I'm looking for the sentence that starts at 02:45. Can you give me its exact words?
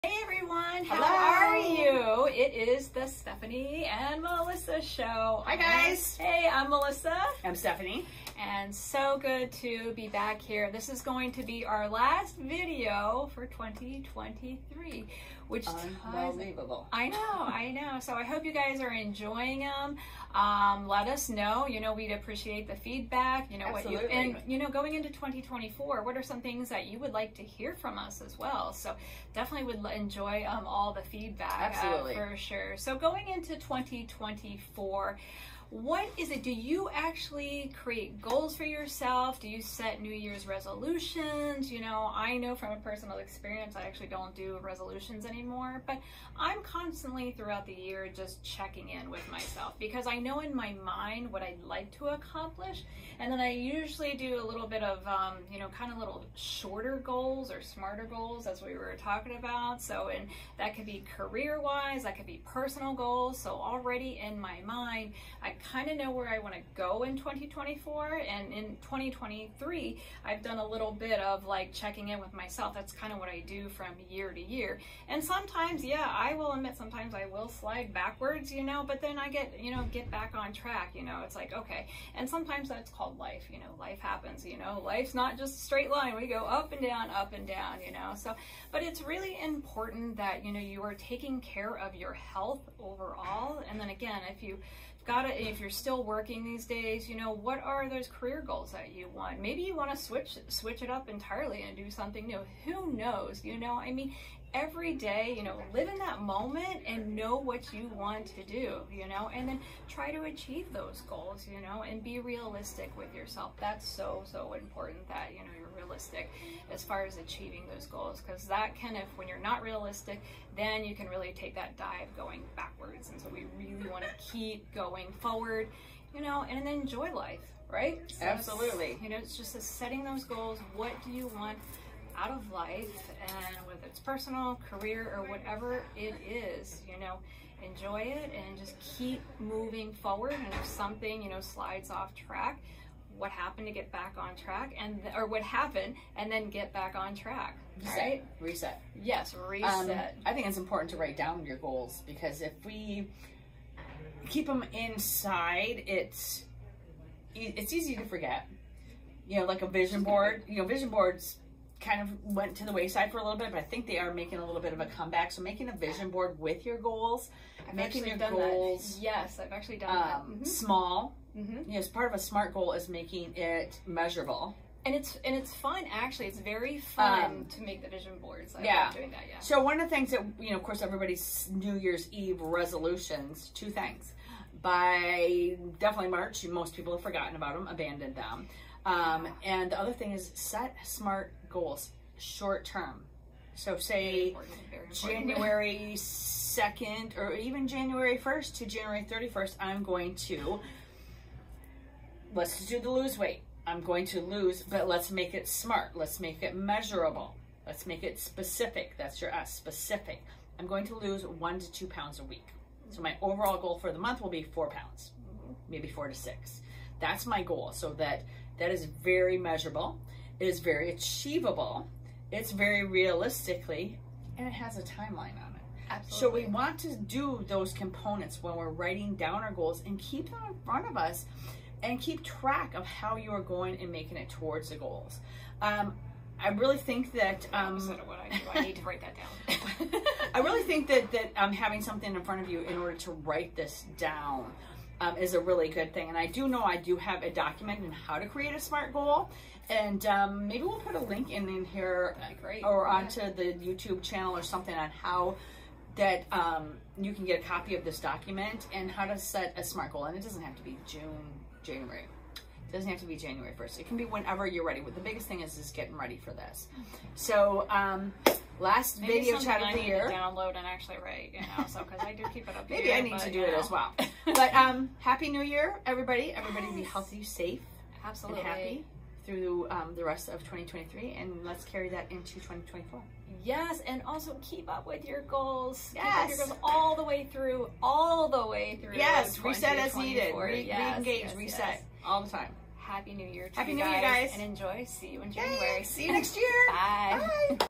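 So making a vision board with your goals, I've making your goals.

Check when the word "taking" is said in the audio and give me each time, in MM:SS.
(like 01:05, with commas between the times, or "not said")
01:30.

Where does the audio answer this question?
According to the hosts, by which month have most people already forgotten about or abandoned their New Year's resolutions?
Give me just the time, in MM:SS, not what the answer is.
03:06.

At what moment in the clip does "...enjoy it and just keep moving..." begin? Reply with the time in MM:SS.
02:17.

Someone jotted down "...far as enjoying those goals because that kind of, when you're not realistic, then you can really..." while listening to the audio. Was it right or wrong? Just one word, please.
wrong.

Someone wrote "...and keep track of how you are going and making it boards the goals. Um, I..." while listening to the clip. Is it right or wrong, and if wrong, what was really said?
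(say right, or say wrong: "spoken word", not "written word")
wrong: "towards", not "boards".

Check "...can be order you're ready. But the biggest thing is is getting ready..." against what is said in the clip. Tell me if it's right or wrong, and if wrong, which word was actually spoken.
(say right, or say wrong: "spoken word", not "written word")
wrong: "whenever", not "order".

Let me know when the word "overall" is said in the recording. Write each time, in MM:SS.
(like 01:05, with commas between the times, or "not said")
01:32, 03:33.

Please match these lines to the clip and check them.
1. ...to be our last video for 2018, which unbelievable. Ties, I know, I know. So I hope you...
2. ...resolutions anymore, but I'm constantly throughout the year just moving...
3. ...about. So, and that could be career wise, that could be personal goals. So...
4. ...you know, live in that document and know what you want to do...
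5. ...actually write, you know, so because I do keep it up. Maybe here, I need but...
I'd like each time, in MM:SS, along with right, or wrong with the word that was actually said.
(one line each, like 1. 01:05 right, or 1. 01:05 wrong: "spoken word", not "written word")
1. 00:11 wrong: "2023", not "2018"
2. 00:44 wrong: "checking", not "moving"
3. 00:59 right
4. 01:45 wrong: "moment", not "document"
5. 04:30 right.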